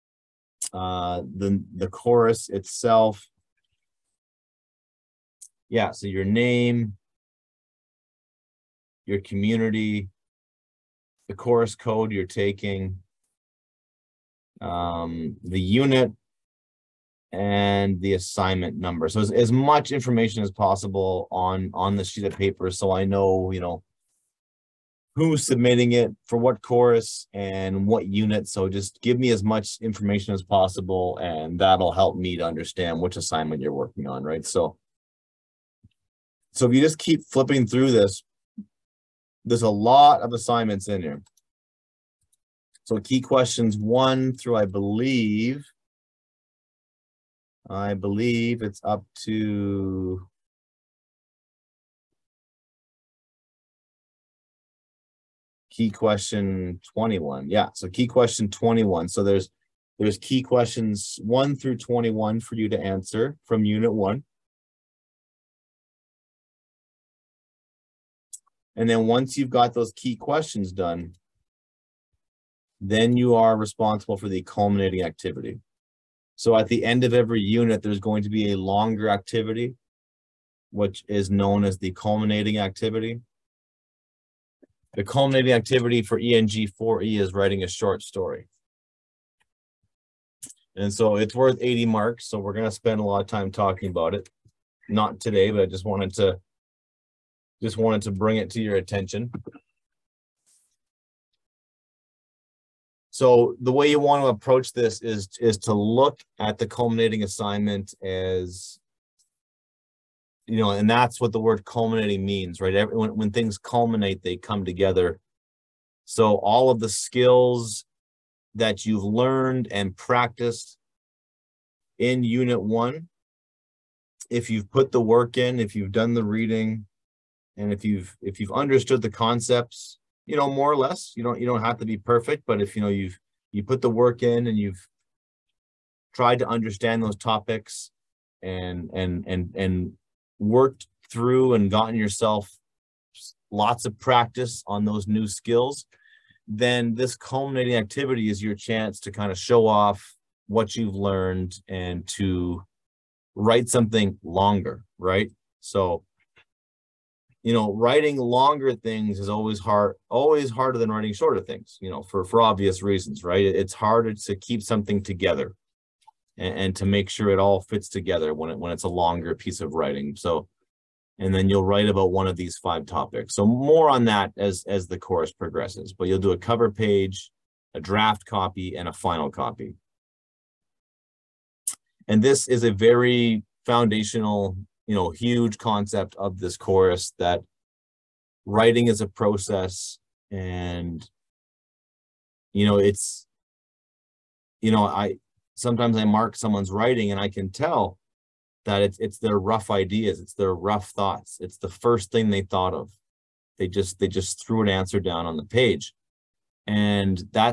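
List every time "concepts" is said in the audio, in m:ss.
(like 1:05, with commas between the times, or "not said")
2:09, 3:05.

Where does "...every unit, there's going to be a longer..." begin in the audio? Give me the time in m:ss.
1:17.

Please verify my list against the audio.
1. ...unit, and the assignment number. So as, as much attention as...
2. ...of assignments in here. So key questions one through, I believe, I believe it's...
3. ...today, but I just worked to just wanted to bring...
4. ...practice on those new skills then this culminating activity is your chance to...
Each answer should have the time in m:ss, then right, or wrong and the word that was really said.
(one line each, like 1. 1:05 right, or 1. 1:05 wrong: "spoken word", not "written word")
1. 0:15 wrong: "information", not "attention"
2. 0:40 right
3. 1:35 wrong: "wanted", not "worked"
4. 2:23 right.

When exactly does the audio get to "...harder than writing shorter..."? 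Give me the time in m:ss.
2:40.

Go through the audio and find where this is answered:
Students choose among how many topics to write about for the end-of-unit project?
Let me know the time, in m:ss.
2:52.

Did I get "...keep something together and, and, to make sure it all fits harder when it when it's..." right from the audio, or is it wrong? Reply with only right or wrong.
wrong.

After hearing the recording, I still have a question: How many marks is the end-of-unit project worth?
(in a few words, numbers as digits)
80.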